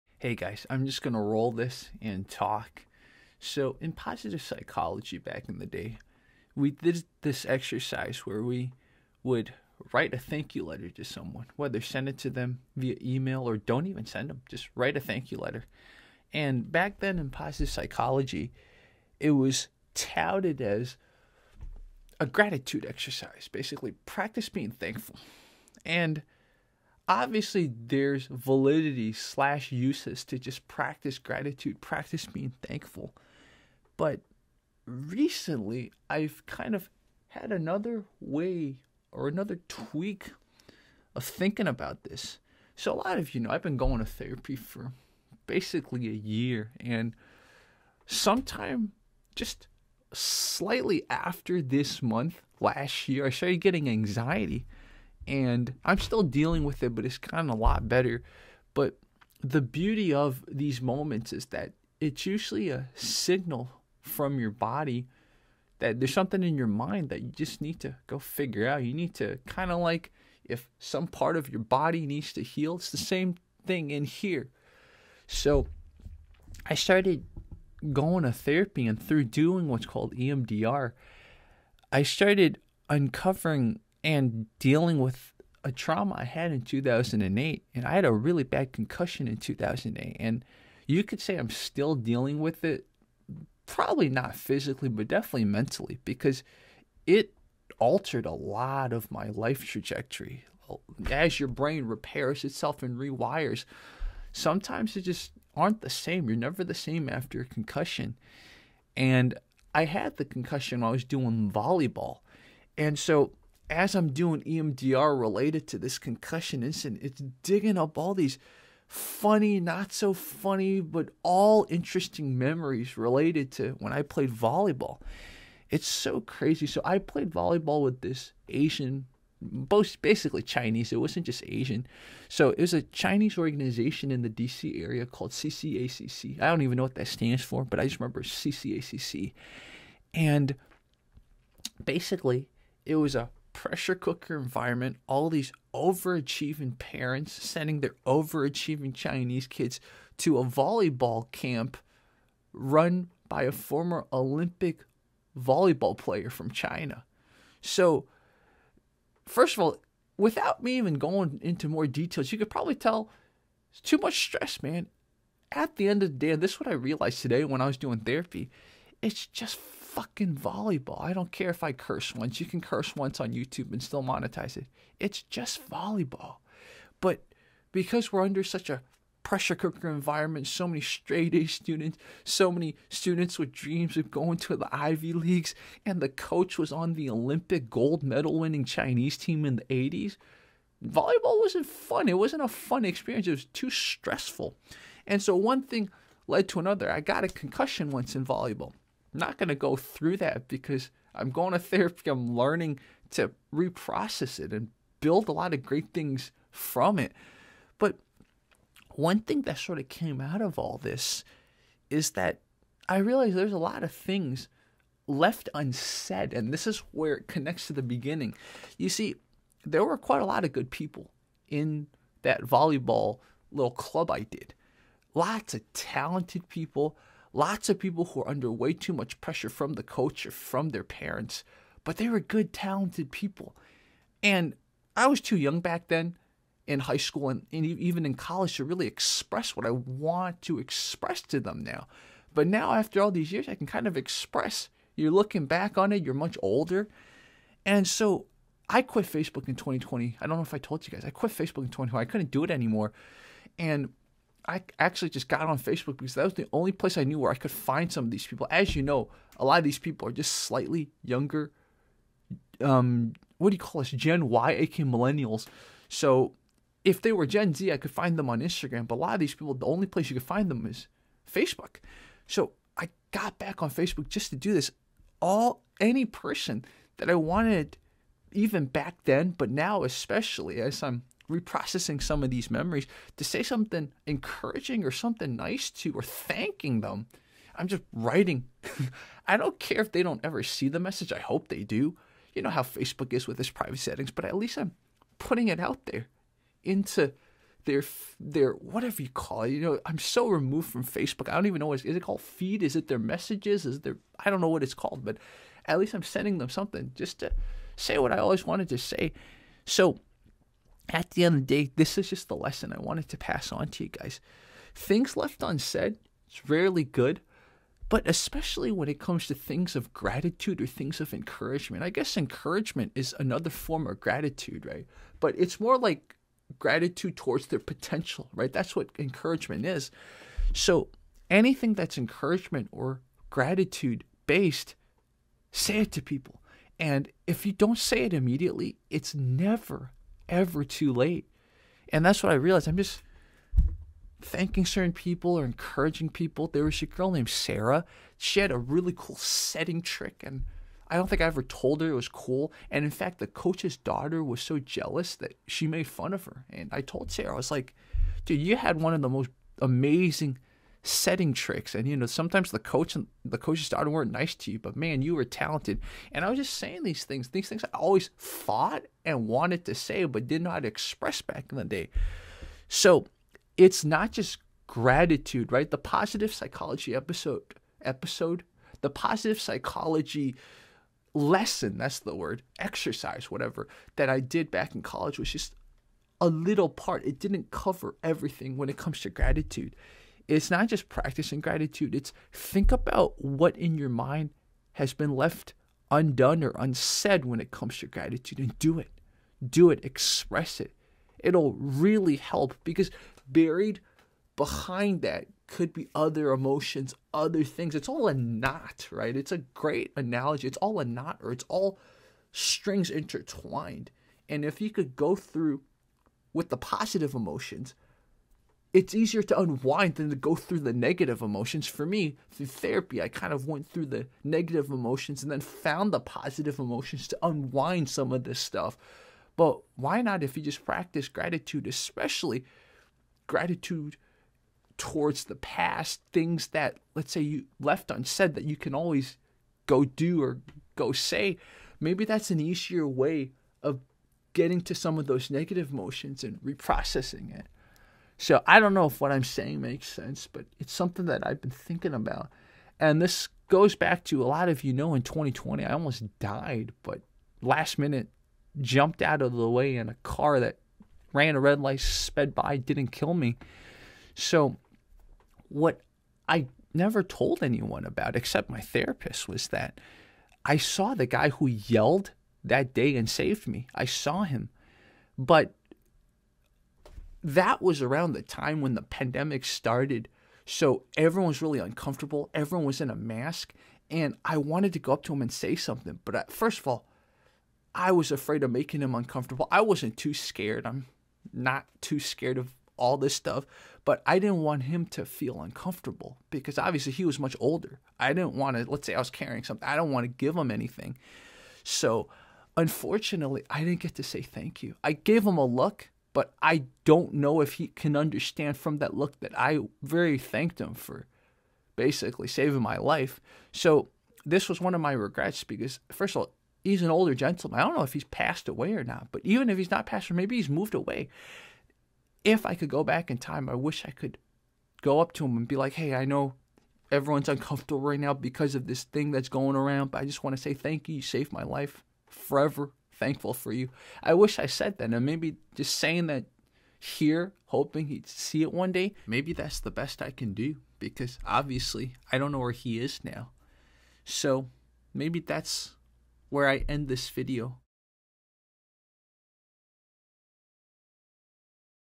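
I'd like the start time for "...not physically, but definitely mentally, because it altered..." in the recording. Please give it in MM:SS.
01:34.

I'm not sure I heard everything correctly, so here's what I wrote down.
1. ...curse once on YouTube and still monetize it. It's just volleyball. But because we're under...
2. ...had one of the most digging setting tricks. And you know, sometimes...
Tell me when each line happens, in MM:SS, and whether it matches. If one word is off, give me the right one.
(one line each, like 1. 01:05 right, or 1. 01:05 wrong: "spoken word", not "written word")
1. 02:52 right
2. 05:58 wrong: "amazing", not "digging".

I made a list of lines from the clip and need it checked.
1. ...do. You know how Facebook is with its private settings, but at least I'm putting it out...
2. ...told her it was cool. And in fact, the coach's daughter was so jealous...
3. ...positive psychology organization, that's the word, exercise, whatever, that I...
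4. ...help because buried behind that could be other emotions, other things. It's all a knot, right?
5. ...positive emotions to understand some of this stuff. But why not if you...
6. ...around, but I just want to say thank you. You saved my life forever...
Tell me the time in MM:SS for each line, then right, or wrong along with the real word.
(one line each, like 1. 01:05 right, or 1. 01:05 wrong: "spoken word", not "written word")
1. 04:51 right
2. 05:51 right
3. 06:18 wrong: "lesson", not "organization"
4. 06:42 right
5. 07:05 wrong: "unwind", not "understand"
6. 08:49 right.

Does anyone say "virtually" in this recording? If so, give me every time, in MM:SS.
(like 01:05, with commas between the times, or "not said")
not said.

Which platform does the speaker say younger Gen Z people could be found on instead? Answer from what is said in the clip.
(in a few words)
Instagram.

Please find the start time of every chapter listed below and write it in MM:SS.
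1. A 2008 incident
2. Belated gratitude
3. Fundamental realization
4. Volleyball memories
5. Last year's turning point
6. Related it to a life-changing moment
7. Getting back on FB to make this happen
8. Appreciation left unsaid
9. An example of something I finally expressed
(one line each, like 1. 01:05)
1. 01:27
2. 06:19
3. 05:14
4. 01:53
5. 00:42
6. 07:27
7. 04:08
8. 03:27
9. 05:46.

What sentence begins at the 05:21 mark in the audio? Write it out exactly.
I guess encouragement is another form of gratitude, right?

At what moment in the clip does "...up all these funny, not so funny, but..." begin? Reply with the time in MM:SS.
01:57.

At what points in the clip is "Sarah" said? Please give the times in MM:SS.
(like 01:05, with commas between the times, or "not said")
05:47, 05:57.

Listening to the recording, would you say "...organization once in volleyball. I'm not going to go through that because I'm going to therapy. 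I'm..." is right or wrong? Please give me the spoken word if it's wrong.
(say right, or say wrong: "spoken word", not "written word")
wrong: "concussion", not "organization".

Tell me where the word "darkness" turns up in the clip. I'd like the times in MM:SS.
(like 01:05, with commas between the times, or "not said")
not said.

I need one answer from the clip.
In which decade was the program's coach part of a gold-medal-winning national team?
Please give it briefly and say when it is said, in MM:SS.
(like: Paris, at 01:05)
the 80s, at 03:09.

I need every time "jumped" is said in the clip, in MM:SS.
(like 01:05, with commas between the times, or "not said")
07:38.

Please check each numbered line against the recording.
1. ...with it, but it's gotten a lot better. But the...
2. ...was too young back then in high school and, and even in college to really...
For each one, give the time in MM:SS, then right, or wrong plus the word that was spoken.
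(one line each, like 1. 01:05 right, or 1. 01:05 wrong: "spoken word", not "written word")
1. 00:56 right
2. 03:55 right.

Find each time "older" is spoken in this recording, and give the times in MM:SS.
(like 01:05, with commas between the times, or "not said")
04:06, 08:17, 08:36.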